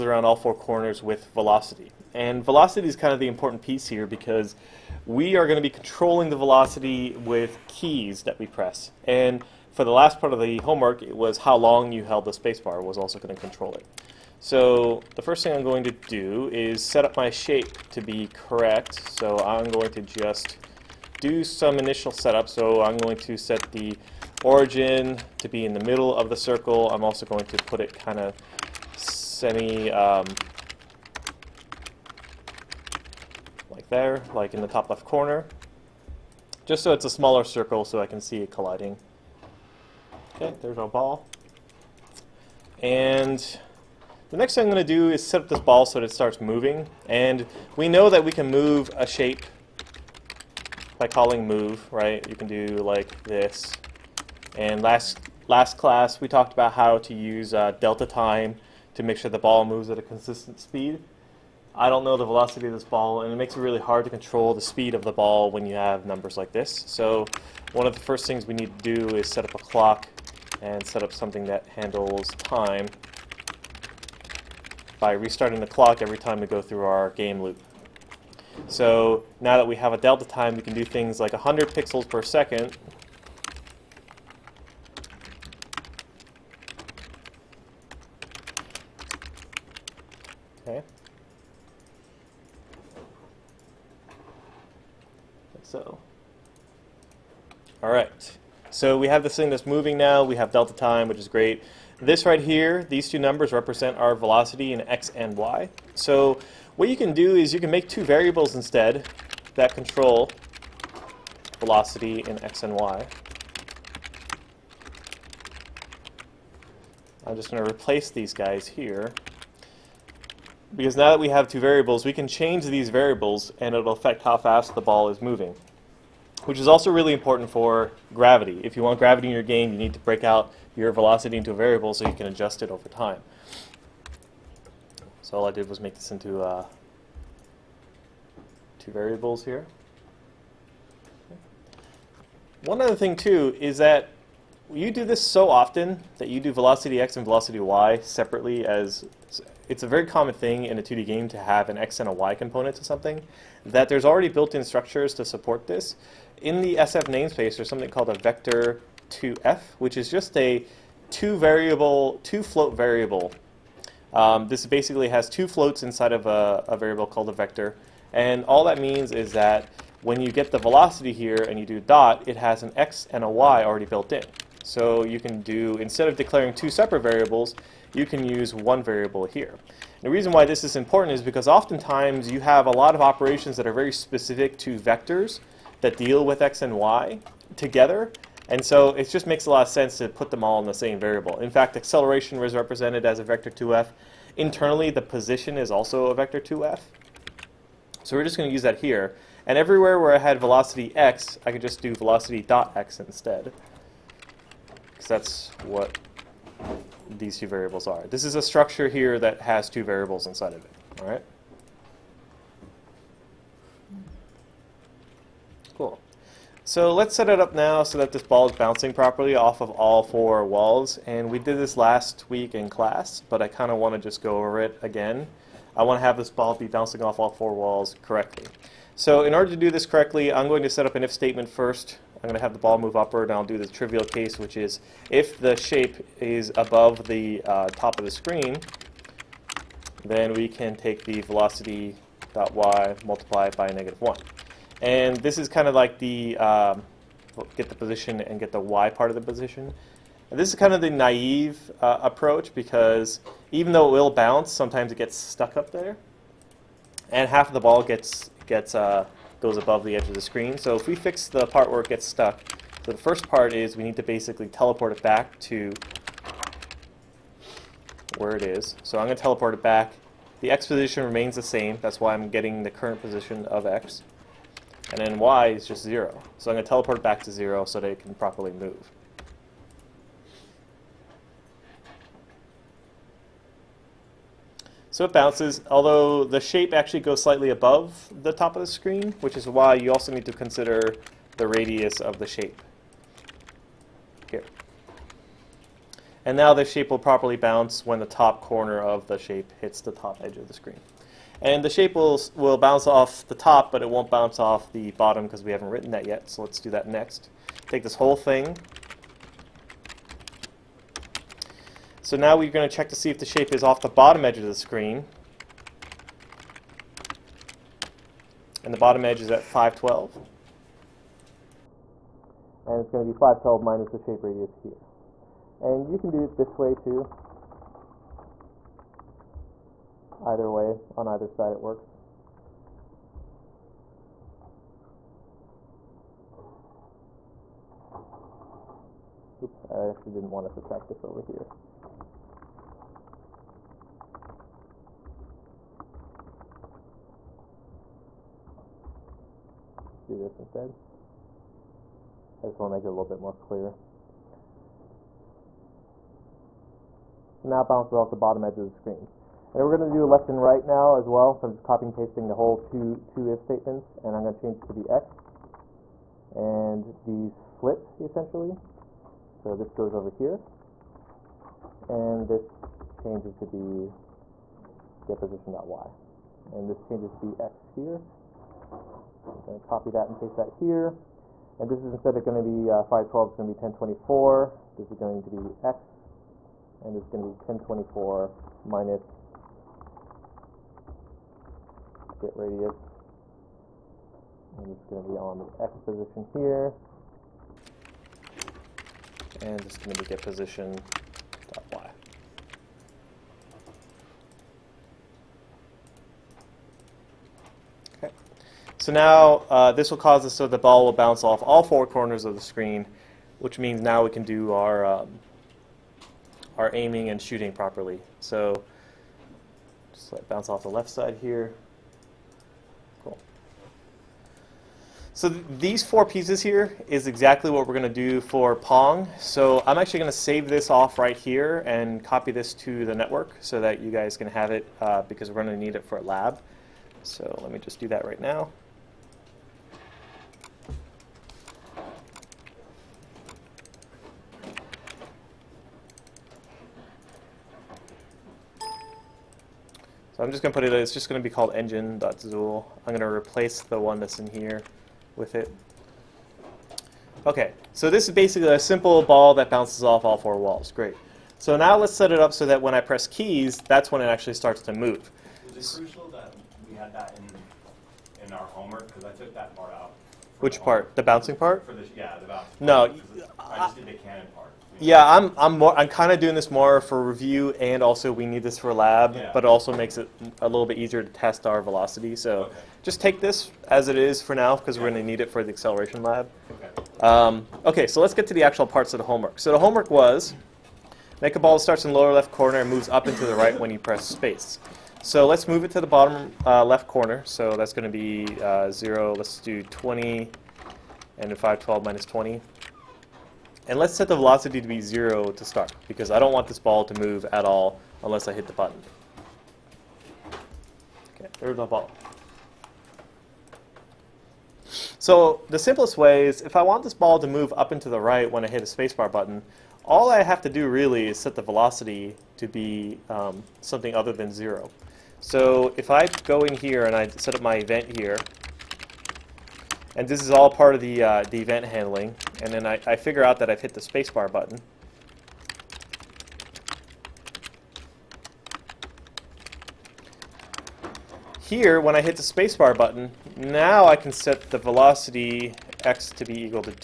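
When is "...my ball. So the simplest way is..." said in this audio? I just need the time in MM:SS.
08:31.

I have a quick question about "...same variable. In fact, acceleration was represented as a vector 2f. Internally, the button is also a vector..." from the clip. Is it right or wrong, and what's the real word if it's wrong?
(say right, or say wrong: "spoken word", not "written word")
wrong: "position", not "button".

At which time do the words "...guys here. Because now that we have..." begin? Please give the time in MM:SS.
01:58.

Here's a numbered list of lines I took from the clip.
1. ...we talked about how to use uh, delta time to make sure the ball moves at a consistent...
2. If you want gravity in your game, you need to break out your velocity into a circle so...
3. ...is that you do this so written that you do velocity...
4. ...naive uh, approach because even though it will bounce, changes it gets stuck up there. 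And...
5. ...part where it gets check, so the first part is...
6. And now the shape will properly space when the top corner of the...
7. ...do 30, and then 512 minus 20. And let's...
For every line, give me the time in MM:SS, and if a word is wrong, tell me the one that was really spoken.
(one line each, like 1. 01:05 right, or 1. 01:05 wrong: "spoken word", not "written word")
1. 00:56 right
2. 02:08 wrong: "variable", not "circle"
3. 02:23 wrong: "often", not "written"
4. 04:10 wrong: "sometimes", not "changes"
5. 04:21 wrong: "stuck", not "check"
6. 04:56 wrong: "bounce", not "space"
7. 08:19 wrong: "20", not "30".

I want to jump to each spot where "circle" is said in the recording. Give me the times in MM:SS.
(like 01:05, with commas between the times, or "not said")
00:26, 00:37.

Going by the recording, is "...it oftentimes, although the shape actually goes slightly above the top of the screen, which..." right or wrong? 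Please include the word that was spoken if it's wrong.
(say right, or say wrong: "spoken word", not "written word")
wrong: "bounces", not "oftentimes".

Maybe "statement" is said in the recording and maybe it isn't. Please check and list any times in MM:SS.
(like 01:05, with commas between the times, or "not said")
03:51, 06:03.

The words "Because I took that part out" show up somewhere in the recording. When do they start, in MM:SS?
07:48.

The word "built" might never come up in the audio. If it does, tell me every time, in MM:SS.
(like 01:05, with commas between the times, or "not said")
02:34, 02:53.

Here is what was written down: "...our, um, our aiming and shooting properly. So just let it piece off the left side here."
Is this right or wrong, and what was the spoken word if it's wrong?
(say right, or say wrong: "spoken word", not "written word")
wrong: "bounce", not "piece".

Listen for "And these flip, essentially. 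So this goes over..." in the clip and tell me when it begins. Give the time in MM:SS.
06:06.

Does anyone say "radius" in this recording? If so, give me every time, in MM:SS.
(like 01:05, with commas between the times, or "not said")
04:51, 05:24, 06:32.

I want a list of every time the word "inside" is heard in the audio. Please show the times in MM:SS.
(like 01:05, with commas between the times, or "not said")
02:45, 03:30.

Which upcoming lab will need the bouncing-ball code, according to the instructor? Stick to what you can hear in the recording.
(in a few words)
acceleration lab.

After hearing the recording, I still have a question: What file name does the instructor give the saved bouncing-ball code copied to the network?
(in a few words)
engine.zool.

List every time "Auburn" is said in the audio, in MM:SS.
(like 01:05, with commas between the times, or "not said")
not said.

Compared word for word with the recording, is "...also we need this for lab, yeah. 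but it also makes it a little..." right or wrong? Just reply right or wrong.
right.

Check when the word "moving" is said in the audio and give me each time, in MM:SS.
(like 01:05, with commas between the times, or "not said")
00:46, 01:39, 02:05.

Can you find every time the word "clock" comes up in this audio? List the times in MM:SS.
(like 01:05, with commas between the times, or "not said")
01:09, 01:15.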